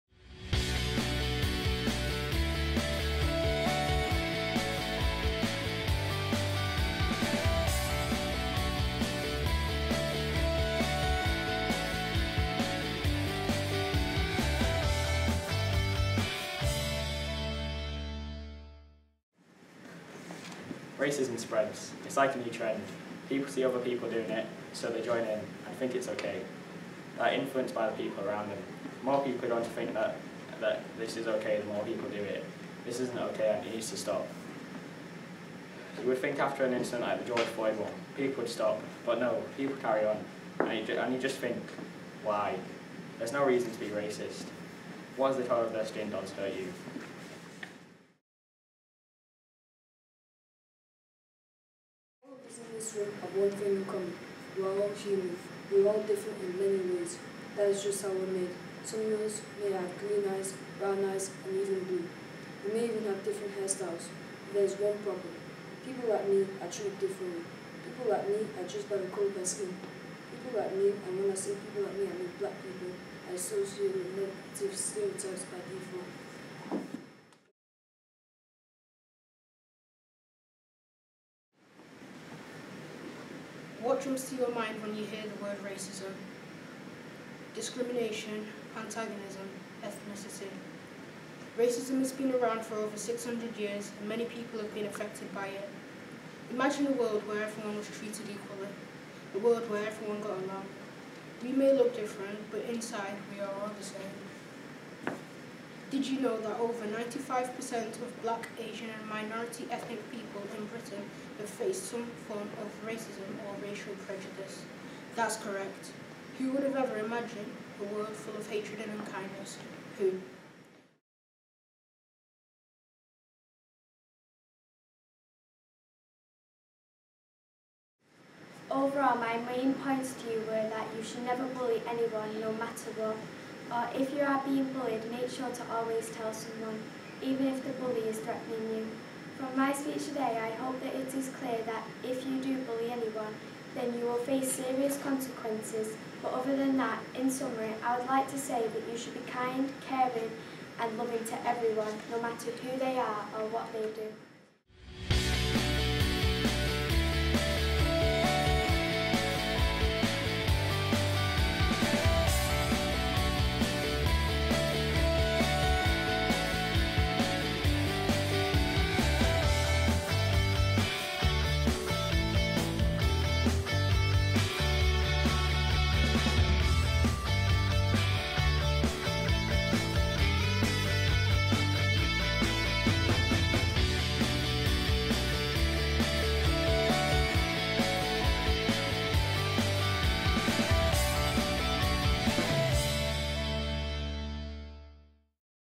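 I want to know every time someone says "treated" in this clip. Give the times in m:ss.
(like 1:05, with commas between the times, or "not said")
1:06, 1:37.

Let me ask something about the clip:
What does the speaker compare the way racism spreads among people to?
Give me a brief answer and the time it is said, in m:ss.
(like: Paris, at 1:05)
A new trend, at 0:22.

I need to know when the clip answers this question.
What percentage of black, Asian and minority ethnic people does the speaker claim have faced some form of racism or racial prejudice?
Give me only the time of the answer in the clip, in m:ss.
1:46.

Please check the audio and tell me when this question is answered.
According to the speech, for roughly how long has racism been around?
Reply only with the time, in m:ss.
1:32.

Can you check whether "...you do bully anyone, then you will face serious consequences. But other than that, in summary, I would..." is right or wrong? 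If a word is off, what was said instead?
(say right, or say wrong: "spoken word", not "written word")
right.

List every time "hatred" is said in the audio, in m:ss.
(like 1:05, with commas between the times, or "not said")
1:58.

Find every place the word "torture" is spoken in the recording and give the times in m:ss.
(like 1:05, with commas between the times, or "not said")
not said.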